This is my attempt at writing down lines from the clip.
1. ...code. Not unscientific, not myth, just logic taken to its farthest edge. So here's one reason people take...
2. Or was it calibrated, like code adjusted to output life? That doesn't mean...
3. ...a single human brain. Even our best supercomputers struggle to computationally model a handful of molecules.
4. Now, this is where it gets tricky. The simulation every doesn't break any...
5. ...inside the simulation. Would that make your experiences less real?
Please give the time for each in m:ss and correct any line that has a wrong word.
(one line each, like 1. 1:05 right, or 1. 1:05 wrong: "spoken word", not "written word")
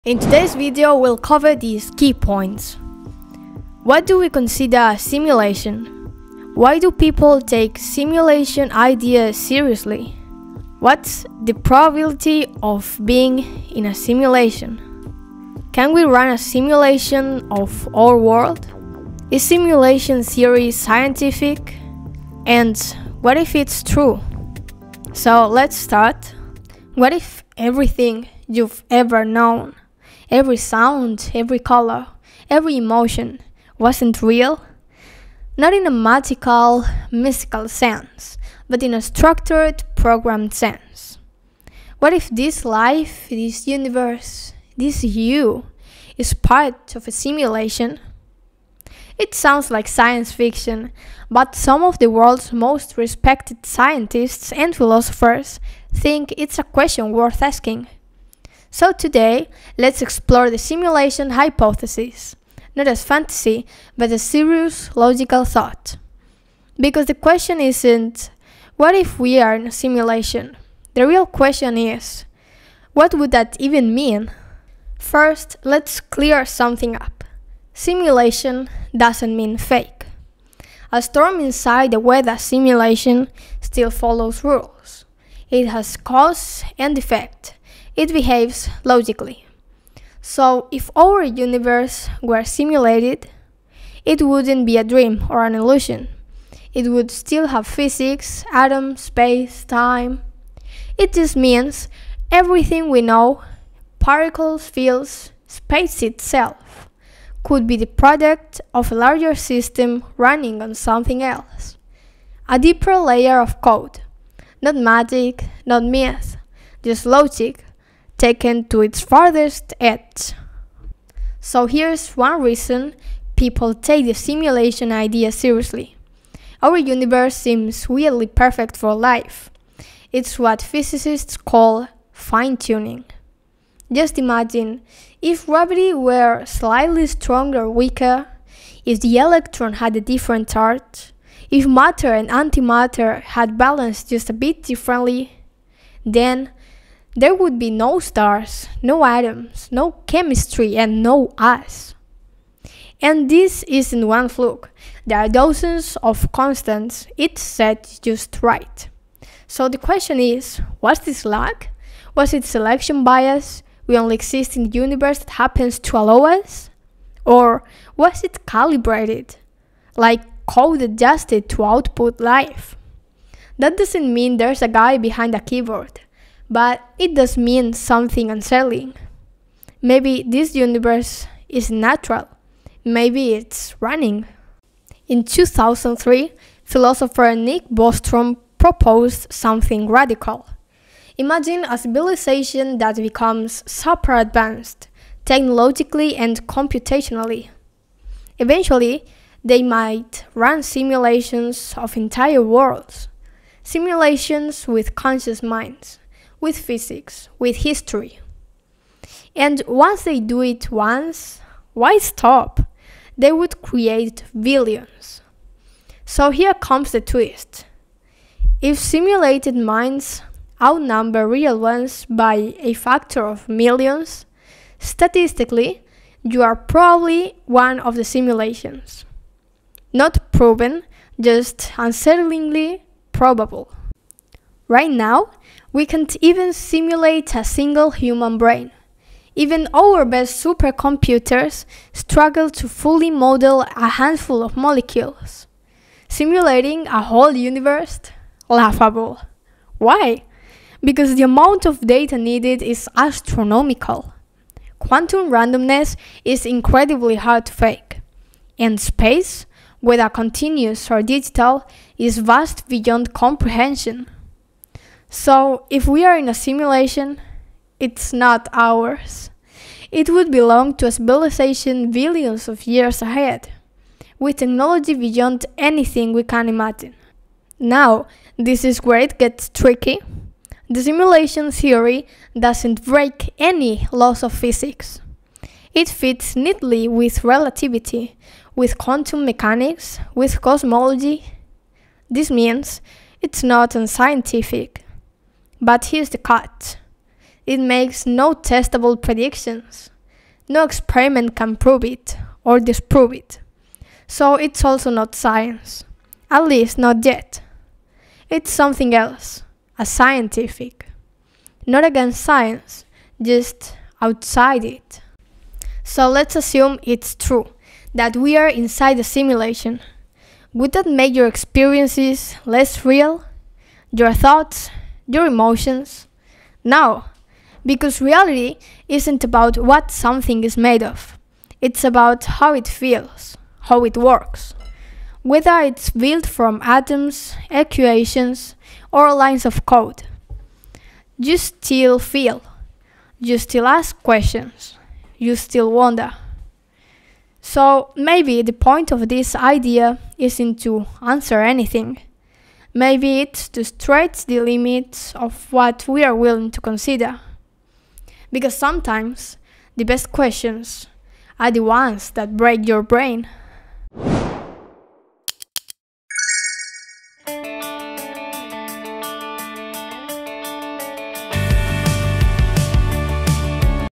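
1. 1:53 wrong: "magic", not "unscientific"
2. 2:47 right
3. 3:57 wrong: "fully", not "computationally"
4. 4:37 wrong: "theory", not "every"
5. 5:18 right.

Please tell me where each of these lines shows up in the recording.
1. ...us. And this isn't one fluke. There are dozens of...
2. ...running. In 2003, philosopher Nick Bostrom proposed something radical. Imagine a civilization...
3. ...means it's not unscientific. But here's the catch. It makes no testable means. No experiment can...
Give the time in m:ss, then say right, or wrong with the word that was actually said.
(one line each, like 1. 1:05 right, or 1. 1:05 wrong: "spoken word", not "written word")
1. 2:31 right
2. 3:03 right
3. 4:52 wrong: "predictions", not "means".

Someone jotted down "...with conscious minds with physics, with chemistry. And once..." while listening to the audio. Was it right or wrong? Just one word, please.
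wrong.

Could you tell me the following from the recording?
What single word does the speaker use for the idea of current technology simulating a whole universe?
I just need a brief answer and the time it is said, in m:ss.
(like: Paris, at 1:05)
Laughable, at 4:08.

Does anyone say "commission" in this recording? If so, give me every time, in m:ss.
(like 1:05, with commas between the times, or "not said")
not said.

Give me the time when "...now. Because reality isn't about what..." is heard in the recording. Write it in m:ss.
5:26.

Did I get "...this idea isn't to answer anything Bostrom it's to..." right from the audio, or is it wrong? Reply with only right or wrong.
wrong.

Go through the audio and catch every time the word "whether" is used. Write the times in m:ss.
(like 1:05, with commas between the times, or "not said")
4:19, 5:35.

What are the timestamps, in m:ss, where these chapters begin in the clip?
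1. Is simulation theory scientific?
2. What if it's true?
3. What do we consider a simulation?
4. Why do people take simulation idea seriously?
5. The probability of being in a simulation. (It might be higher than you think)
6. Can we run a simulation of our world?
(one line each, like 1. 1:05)
1. 4:37
2. 5:16
3. 1:16
4. 2:01
5. 3:05
6. 3:54.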